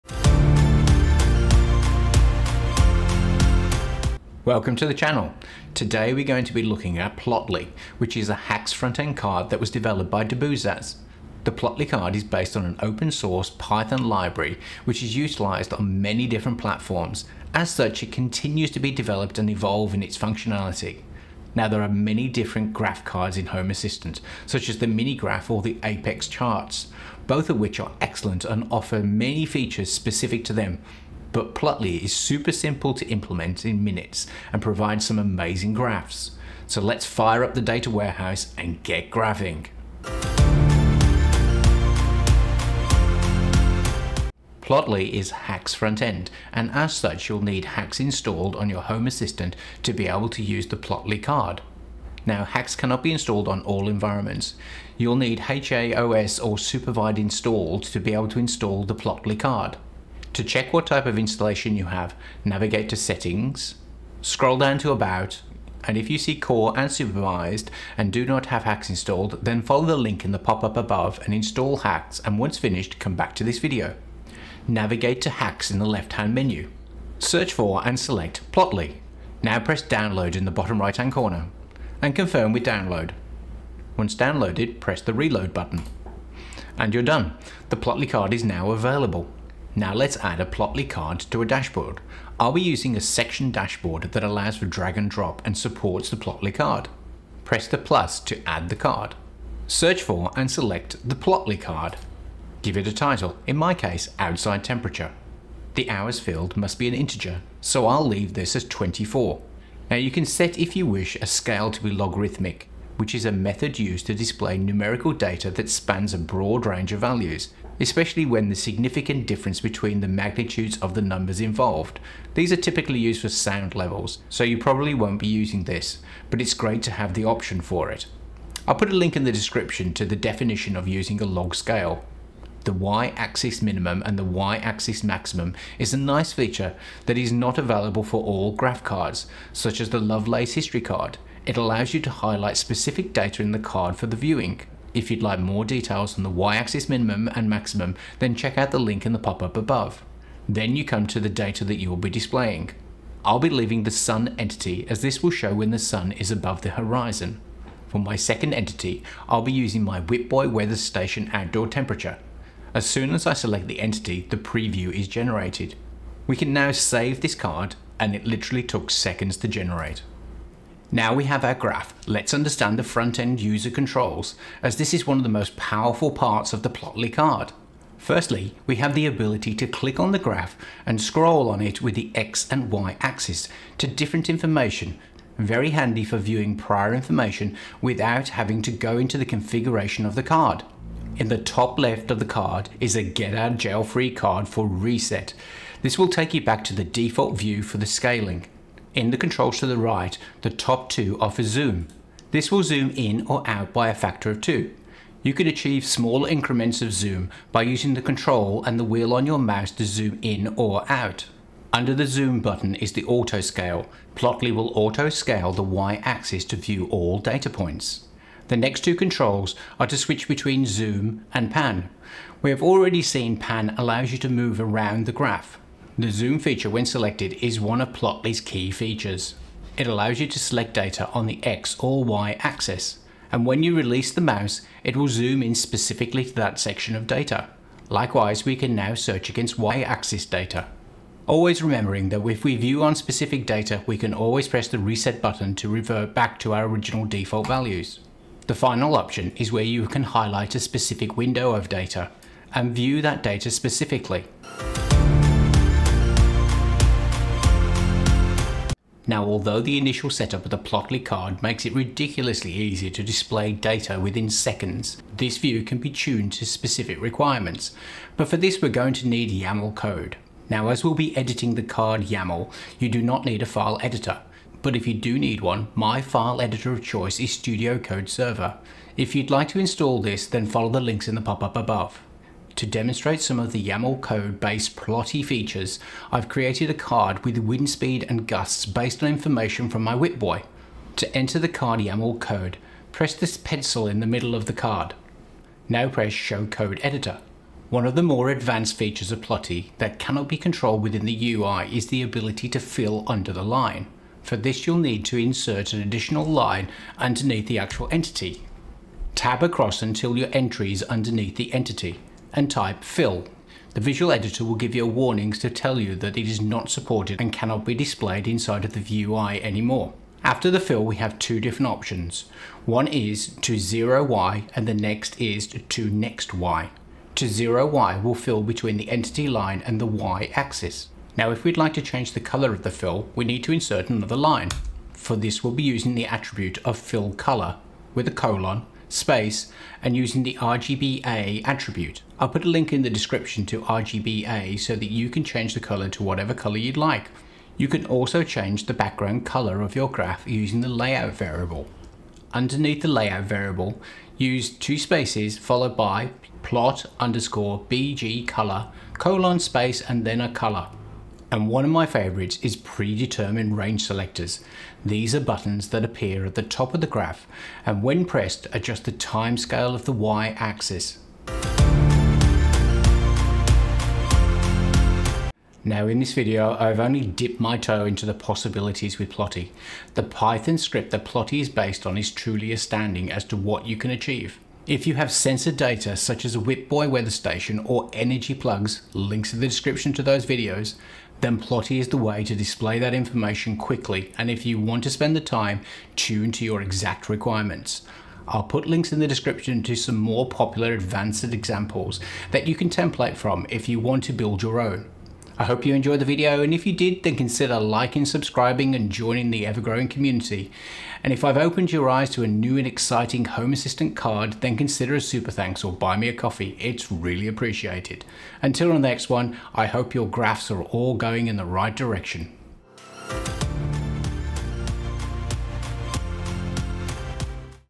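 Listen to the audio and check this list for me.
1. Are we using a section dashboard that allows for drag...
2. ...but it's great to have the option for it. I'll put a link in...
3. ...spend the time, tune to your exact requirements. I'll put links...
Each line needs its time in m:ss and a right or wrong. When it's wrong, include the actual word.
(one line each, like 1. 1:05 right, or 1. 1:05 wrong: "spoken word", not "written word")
1. 1:32 right
2. 2:06 right
3. 6:34 right.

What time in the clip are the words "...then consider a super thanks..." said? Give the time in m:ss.
6:54.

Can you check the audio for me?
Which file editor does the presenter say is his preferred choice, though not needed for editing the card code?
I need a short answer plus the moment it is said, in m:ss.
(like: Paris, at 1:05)
Studio Code Server, at 4:37.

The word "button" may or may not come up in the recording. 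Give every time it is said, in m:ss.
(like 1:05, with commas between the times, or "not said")
1:25, 3:32, 4:05, 6:05.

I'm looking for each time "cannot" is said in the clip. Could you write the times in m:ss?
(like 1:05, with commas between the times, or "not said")
0:52, 4:59, 5:17.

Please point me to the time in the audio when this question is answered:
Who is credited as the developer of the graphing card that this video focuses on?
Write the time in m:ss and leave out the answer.
0:10.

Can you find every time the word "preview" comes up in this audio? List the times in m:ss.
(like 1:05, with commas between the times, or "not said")
2:44.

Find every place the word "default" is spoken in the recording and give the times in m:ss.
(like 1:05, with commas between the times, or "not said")
3:16, 4:07.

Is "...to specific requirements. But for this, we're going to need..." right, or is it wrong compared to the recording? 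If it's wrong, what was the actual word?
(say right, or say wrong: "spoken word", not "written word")
right.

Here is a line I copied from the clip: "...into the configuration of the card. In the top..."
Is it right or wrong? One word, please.
right.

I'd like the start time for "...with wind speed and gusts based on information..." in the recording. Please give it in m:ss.
4:47.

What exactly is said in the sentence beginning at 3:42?
We have already seen pan allows you to move around the graph.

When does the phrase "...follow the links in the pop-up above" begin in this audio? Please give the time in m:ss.
4:40.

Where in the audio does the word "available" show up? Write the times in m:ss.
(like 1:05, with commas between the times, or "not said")
1:28, 2:17.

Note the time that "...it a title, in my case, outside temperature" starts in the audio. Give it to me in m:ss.
1:42.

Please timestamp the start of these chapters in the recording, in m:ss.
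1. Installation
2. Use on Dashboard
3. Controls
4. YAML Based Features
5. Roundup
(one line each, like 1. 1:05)
1. 0:41
2. 1:32
3. 2:50
4. 4:16
5. 6:13.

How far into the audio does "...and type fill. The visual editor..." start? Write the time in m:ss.
5:12.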